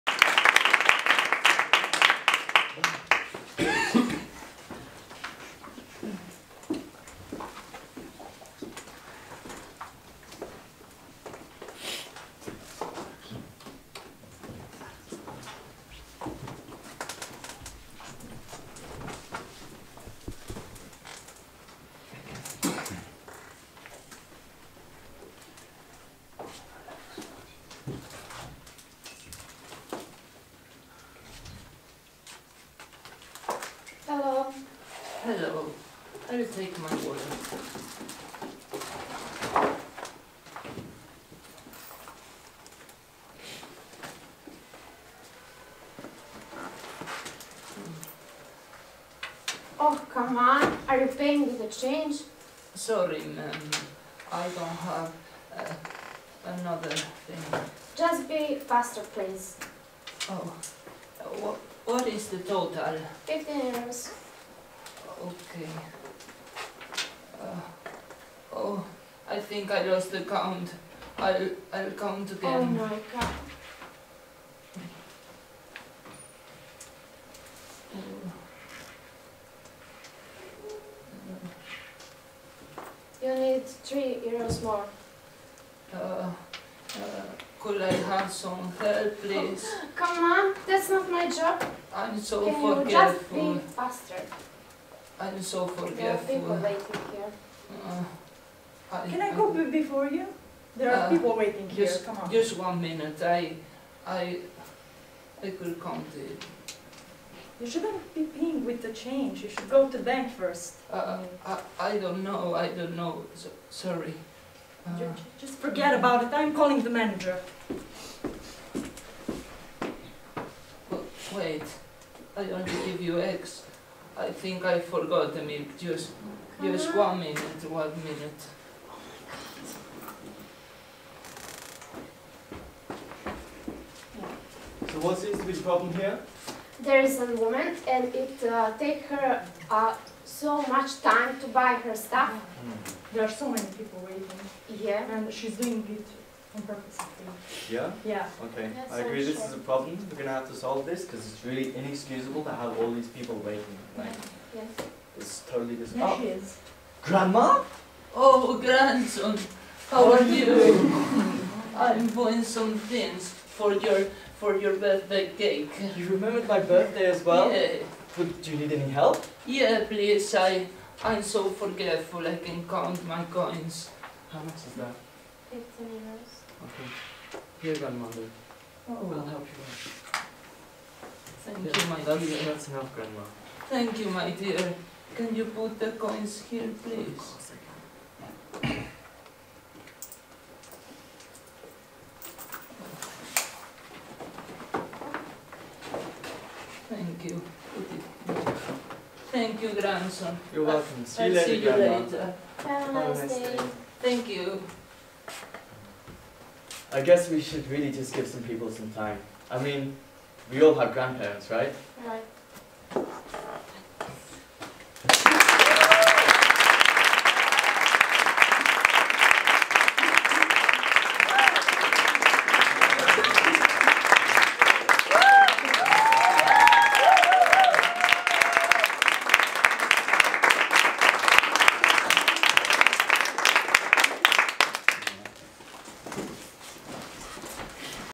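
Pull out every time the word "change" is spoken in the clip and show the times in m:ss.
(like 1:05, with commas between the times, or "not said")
0:51, 1:48.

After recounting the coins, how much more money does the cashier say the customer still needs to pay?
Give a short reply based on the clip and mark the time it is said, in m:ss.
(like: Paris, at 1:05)
3 euros, at 1:23.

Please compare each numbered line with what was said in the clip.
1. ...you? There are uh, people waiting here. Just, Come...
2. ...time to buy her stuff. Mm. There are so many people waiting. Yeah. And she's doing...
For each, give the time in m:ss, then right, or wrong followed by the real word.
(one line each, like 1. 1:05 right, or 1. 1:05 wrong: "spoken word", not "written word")
1. 1:40 right
2. 2:21 right.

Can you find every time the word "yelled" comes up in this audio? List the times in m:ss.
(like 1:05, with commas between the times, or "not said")
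not said.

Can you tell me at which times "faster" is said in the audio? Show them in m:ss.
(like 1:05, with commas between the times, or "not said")
0:58, 1:33.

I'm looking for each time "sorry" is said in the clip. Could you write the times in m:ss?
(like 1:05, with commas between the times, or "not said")
0:52, 1:53.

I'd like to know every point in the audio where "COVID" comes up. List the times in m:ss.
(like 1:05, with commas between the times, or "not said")
not said.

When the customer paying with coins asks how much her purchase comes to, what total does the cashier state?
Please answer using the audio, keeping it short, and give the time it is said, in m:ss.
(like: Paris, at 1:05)
15 euros, at 1:03.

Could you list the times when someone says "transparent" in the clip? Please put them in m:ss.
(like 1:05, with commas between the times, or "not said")
not said.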